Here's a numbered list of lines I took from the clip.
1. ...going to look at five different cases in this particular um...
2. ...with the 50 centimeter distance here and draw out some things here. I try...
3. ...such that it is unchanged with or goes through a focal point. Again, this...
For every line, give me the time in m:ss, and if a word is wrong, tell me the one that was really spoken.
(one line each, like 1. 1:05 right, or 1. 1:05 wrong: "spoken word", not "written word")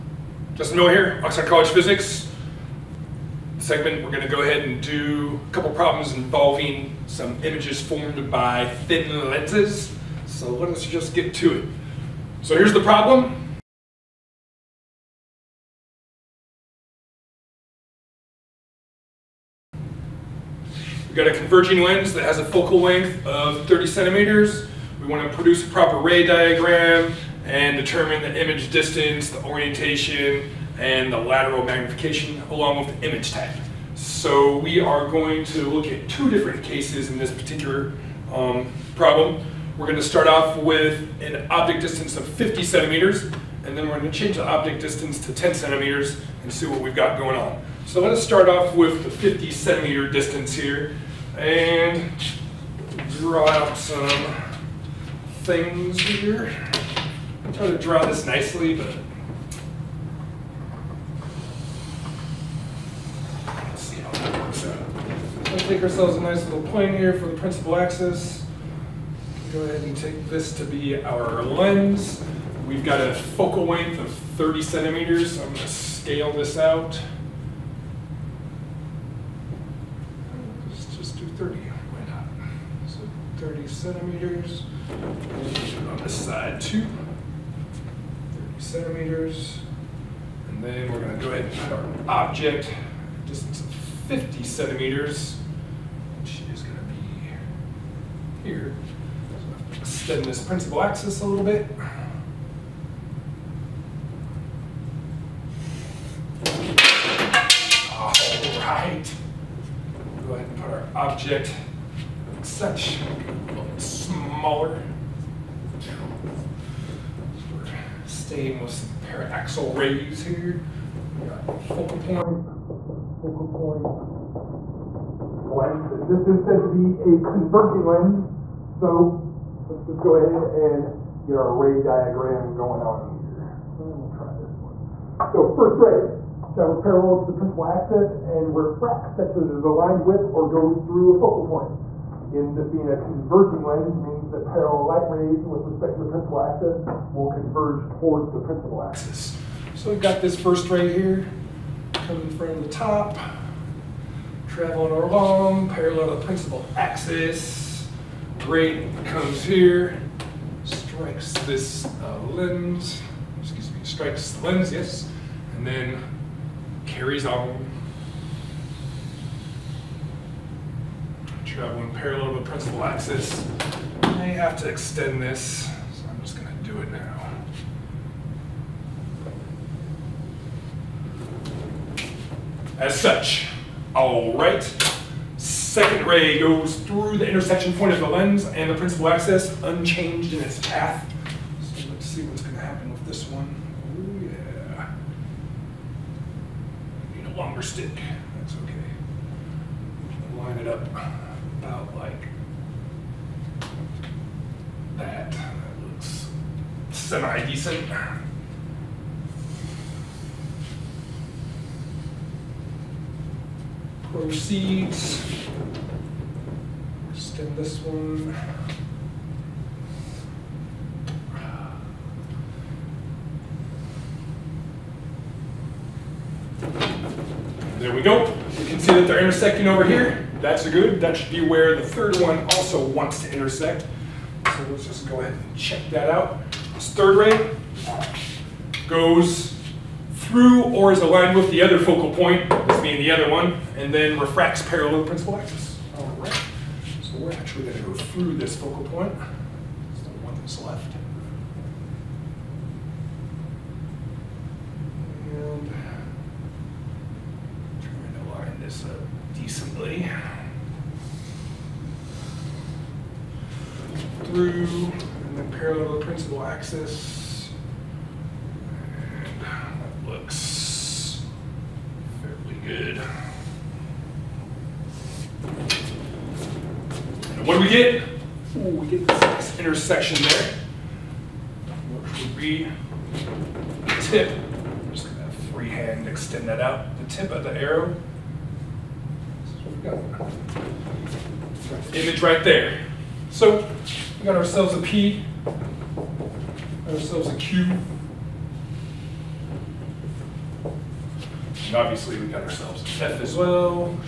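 1. 0:35 wrong: "two", not "five"
2. 0:48 right
3. 2:19 wrong: "aligned", not "unchanged".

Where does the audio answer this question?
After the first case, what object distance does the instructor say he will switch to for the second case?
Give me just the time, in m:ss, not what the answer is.
0:45.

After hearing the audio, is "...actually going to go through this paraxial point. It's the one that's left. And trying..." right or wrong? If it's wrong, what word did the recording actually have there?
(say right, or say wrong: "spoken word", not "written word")
wrong: "focal", not "paraxial".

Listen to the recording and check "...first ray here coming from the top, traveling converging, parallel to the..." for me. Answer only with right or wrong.
wrong.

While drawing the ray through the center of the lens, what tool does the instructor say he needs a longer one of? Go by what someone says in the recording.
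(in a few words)
stick.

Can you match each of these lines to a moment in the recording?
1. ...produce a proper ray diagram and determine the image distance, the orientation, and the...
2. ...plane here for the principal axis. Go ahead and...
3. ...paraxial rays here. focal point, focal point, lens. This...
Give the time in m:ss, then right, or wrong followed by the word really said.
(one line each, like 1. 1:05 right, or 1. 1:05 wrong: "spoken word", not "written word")
1. 0:25 right
2. 1:06 right
3. 1:59 right.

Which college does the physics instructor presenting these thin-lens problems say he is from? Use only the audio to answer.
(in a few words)
Oxford College.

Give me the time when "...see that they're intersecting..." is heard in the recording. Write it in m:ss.
3:48.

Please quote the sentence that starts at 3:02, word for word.
As such, all right, second ray goes through the intersection point of the lens and the principal axis, unchanged in its path.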